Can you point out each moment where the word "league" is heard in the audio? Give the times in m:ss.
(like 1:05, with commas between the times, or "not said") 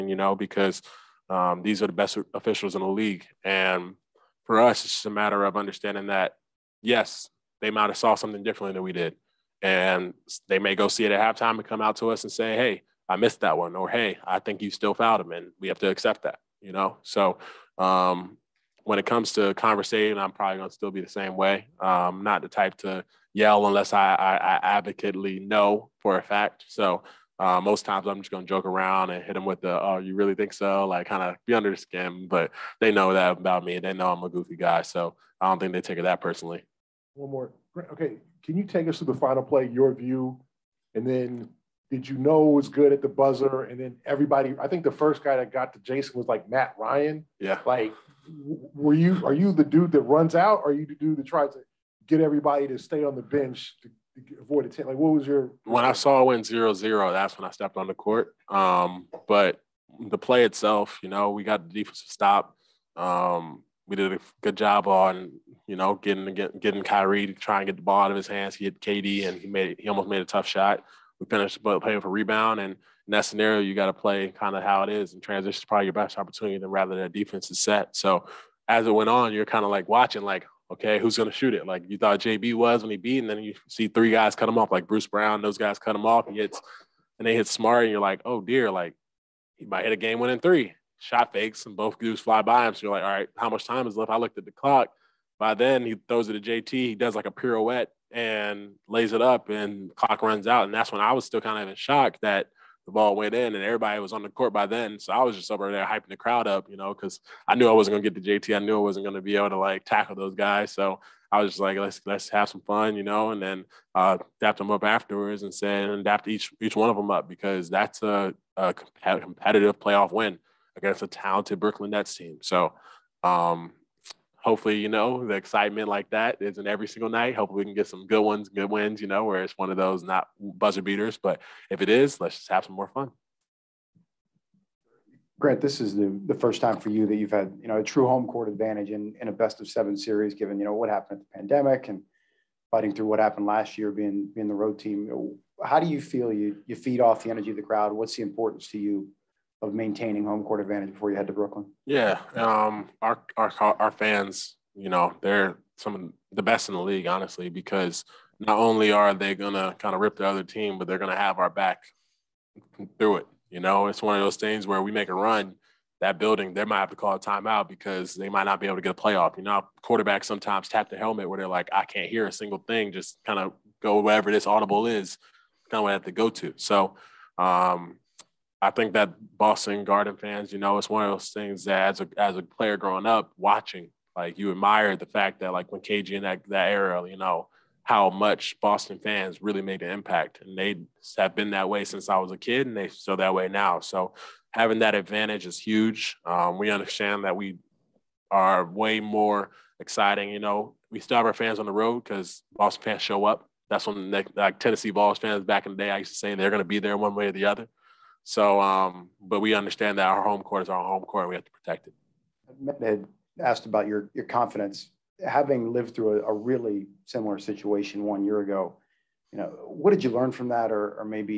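0:02, 2:36.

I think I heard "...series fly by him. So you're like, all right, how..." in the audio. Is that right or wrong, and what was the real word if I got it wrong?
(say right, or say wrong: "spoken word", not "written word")
wrong: "dudes", not "series".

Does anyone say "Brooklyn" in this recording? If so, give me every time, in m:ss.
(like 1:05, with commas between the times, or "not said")
2:01, 2:31.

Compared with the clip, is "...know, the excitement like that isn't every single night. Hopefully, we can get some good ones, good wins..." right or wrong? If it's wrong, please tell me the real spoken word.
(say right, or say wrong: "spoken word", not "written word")
right.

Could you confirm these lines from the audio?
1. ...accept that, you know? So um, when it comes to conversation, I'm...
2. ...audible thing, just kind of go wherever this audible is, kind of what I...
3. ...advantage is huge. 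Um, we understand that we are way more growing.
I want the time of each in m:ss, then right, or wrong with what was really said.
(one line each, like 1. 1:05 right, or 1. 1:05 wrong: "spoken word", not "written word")
1. 0:15 right
2. 2:52 wrong: "single", not "audible"
3. 3:14 wrong: "exciting", not "growing".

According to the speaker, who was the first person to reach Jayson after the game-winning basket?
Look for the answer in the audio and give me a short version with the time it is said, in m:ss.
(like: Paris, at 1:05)
Matt Ryan, at 0:46.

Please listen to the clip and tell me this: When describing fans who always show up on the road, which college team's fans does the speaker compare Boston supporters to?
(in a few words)
Tennessee Vols.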